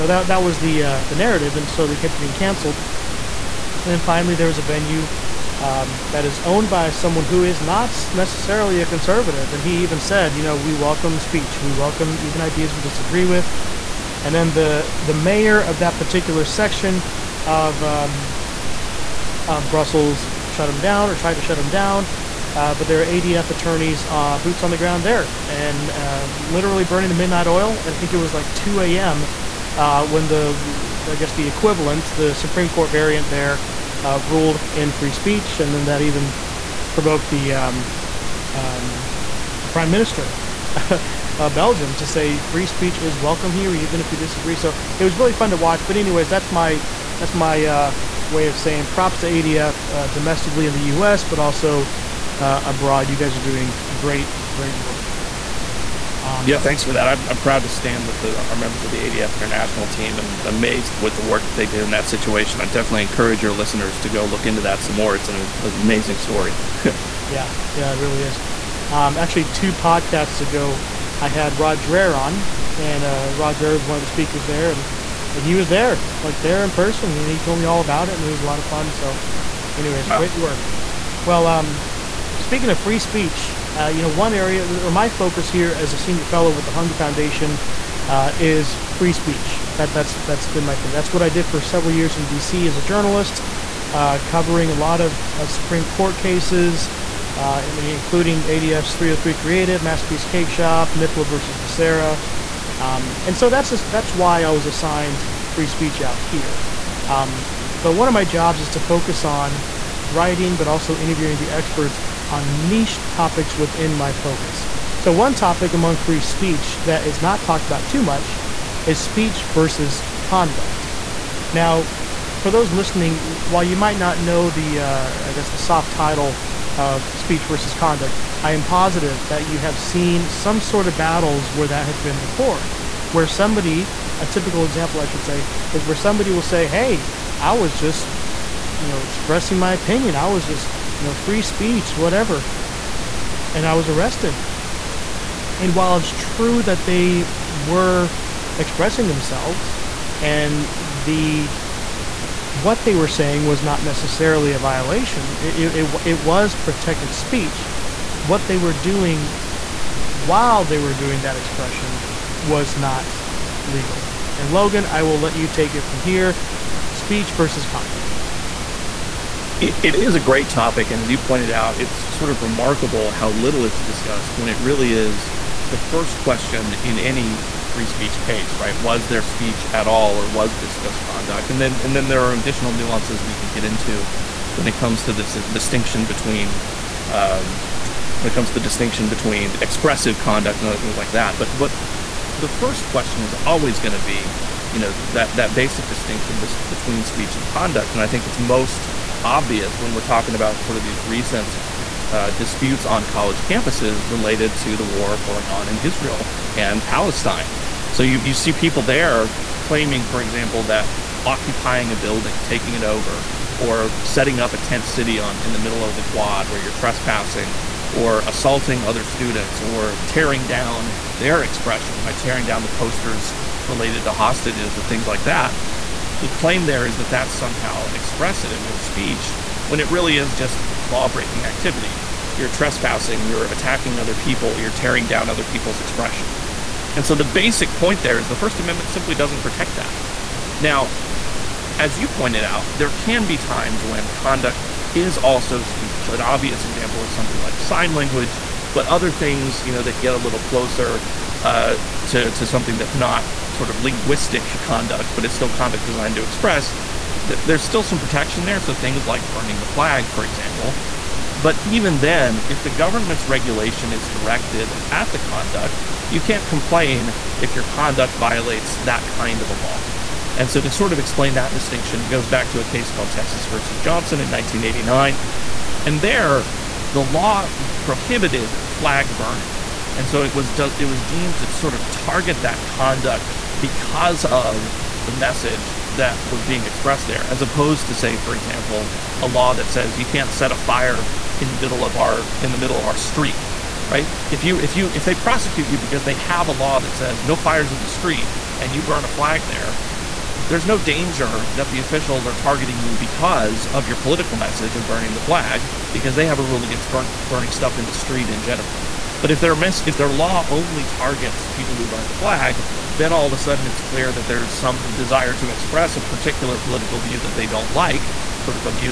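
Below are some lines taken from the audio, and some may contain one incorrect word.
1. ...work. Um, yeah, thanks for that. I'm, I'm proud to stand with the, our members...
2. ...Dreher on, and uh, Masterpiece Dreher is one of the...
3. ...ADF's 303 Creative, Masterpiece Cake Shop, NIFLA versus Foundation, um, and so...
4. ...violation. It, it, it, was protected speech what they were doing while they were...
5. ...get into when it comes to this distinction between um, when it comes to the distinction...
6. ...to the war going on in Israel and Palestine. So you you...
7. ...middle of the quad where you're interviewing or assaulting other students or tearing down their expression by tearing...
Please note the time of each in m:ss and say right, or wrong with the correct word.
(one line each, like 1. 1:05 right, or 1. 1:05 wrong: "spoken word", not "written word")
1. 0:54 right
2. 1:11 wrong: "Rod", not "Masterpiece"
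3. 1:38 wrong: "Becerra", not "Foundation"
4. 2:34 right
5. 3:03 right
6. 3:24 right
7. 3:35 wrong: "trespassing", not "interviewing".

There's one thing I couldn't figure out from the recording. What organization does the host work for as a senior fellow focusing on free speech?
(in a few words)
Hungary Foundation.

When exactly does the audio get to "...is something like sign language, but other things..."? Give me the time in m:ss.
4:07.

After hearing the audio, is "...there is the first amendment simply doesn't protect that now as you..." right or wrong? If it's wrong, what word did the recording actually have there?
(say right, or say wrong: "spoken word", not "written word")
right.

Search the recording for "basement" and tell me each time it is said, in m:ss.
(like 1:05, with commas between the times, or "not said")
not said.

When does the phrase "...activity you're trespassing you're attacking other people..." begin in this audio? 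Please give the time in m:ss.
3:51.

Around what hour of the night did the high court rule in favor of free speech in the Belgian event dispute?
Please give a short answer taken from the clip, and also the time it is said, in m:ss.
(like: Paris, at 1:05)
2 a.m., at 0:28.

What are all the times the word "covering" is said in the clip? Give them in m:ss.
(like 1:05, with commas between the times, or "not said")
1:34.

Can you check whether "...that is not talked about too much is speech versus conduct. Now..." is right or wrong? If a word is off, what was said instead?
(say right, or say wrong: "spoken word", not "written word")
right.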